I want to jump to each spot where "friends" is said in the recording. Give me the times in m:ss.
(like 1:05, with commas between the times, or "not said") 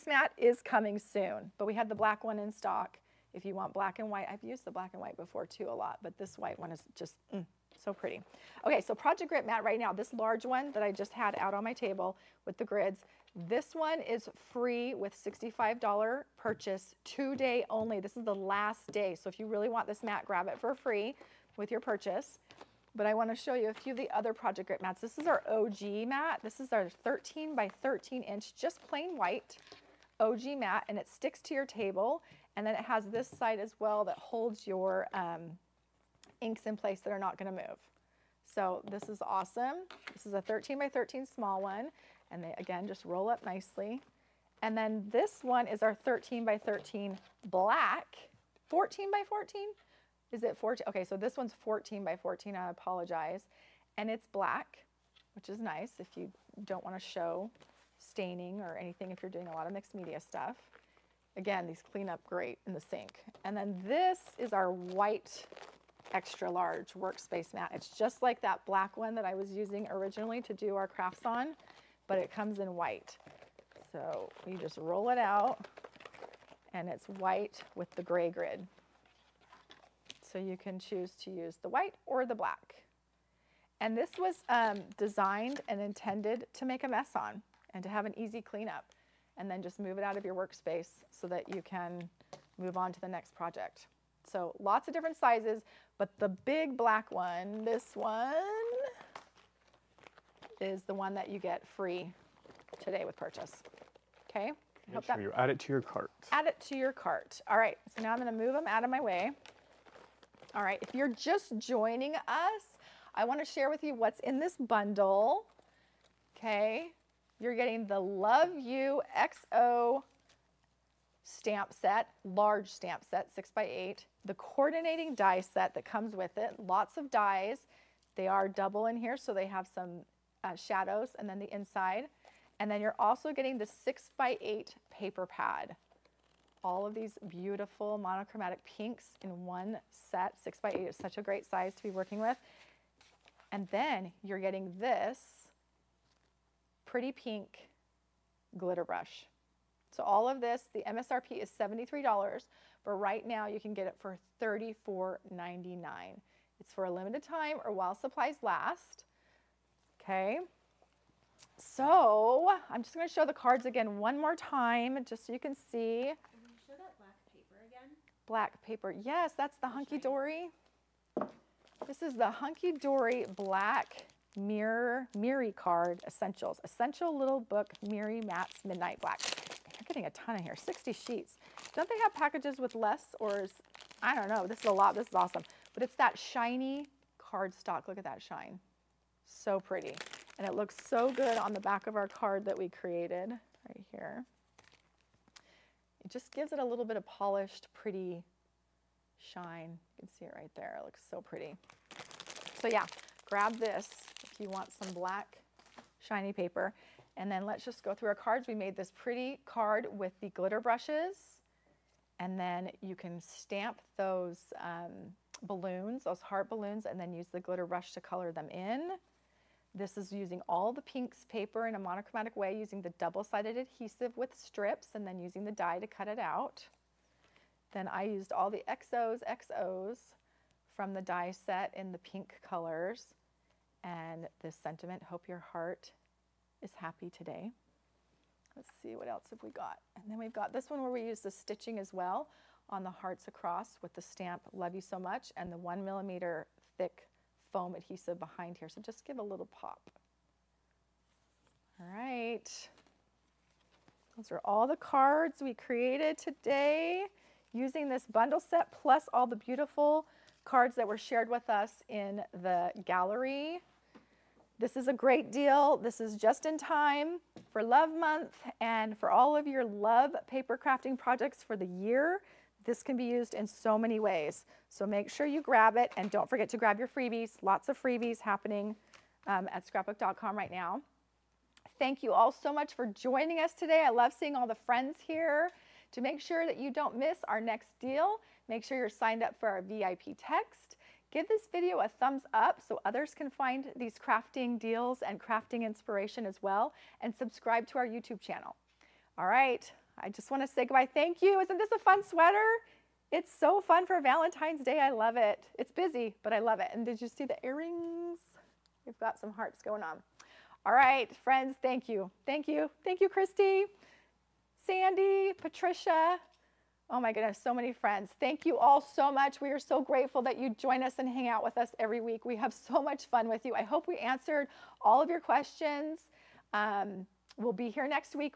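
4:44, 5:11, 5:17.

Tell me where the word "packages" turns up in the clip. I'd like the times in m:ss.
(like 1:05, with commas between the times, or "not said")
3:02.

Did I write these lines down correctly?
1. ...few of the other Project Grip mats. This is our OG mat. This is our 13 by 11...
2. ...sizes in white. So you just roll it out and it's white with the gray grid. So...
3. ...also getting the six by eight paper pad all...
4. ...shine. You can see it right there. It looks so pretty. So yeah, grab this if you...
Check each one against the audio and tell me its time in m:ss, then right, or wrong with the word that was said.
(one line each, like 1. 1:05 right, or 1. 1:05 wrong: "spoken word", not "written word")
1. 0:23 wrong: "13", not "11"
2. 1:12 wrong: "comes", not "sizes"
3. 2:12 right
4. 3:19 right.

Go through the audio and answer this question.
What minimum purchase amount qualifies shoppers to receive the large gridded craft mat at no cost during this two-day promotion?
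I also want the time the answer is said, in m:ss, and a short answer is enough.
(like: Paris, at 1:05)
$65, at 0:15.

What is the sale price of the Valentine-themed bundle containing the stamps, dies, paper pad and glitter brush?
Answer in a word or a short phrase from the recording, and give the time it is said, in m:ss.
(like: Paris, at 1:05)
$34.99, at 2:34.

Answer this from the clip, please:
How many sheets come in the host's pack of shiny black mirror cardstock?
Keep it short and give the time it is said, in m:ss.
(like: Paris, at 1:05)
60, at 3:00.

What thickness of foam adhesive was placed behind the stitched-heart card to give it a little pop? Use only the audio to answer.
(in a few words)
1 millimeter.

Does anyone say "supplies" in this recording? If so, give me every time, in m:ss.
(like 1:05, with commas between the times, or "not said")
2:37.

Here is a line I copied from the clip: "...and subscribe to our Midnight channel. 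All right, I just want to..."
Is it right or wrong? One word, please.
wrong.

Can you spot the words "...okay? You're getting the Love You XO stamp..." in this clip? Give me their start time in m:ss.
1:56.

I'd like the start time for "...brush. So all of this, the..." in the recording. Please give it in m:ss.
2:28.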